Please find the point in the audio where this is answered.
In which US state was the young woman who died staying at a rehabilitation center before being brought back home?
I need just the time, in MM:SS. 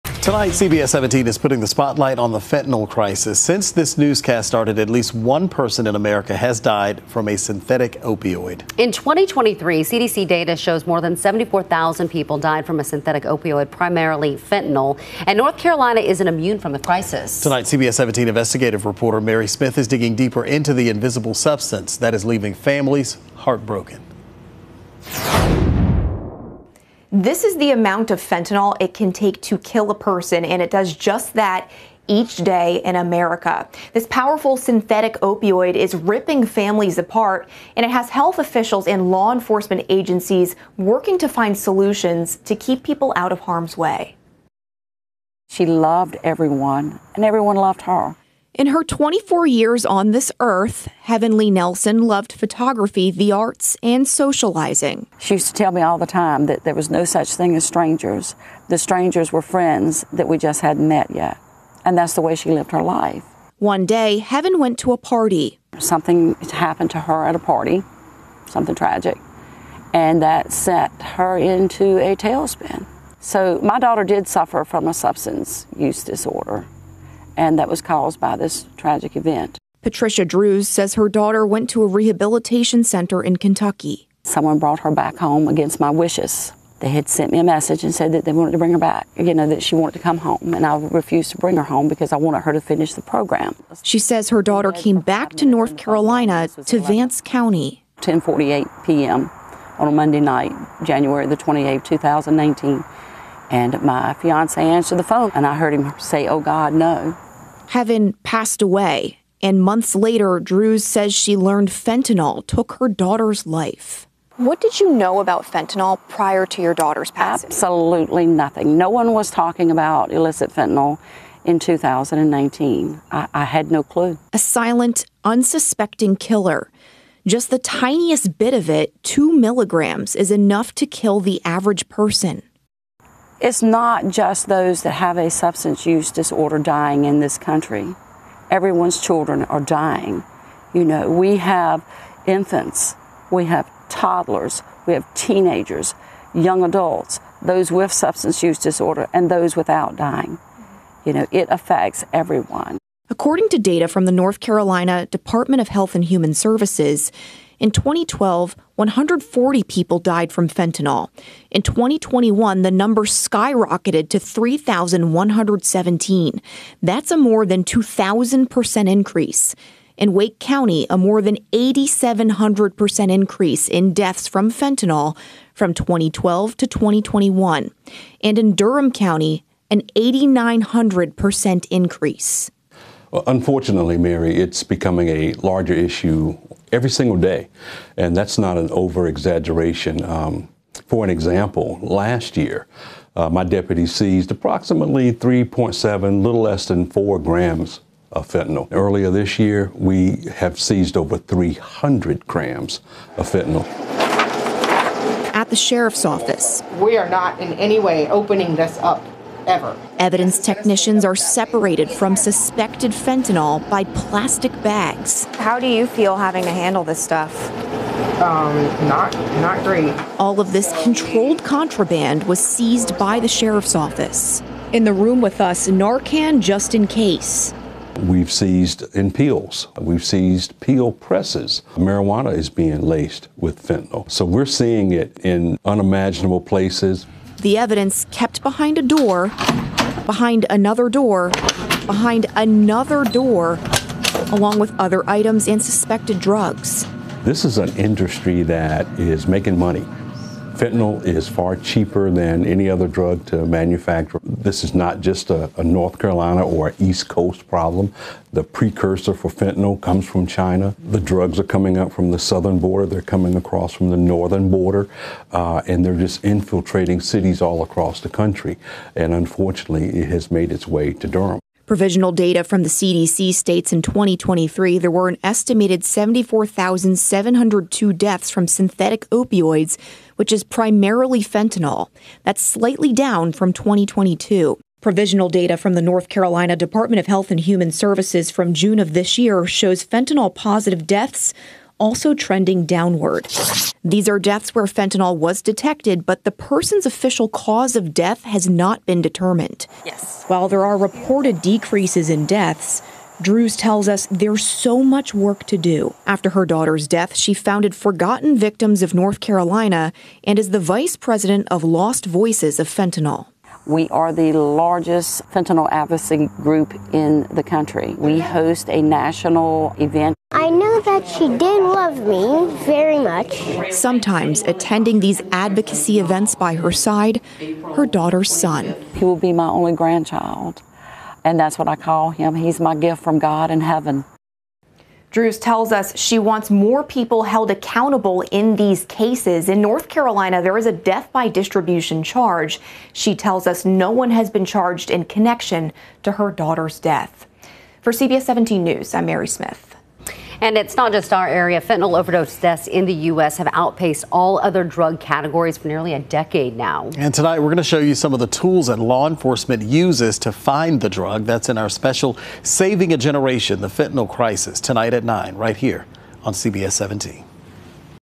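01:23.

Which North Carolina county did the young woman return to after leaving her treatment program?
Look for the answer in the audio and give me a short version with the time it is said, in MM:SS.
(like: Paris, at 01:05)
Vance County, at 01:36.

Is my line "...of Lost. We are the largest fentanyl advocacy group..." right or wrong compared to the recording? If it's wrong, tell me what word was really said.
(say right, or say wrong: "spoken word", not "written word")
wrong: "Fentanyl", not "Lost".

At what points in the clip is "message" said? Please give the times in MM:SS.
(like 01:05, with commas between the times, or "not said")
01:27.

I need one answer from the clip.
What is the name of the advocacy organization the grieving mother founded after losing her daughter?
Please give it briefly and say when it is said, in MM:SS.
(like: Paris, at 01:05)
Forgotten Victims of North Carolina, at 05:07.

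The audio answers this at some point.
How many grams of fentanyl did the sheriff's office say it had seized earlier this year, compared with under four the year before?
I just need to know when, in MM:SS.
03:20.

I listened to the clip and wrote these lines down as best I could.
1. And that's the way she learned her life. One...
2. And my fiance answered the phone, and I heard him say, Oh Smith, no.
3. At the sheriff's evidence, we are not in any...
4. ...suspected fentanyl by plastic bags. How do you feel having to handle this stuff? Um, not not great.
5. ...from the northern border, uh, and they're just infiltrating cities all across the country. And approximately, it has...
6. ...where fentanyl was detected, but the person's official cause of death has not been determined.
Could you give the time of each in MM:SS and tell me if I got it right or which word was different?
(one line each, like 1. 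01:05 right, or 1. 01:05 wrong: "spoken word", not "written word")
1. 01:01 wrong: "lived", not "learned"
2. 01:43 wrong: "God", not "Smith"
3. 03:25 wrong: "office", not "evidence"
4. 03:32 right
5. 04:23 wrong: "unfortunately", not "approximately"
6. 04:54 right.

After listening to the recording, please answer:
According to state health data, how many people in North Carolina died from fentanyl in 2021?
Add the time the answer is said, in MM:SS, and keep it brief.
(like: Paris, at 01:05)
3,117, at 02:44.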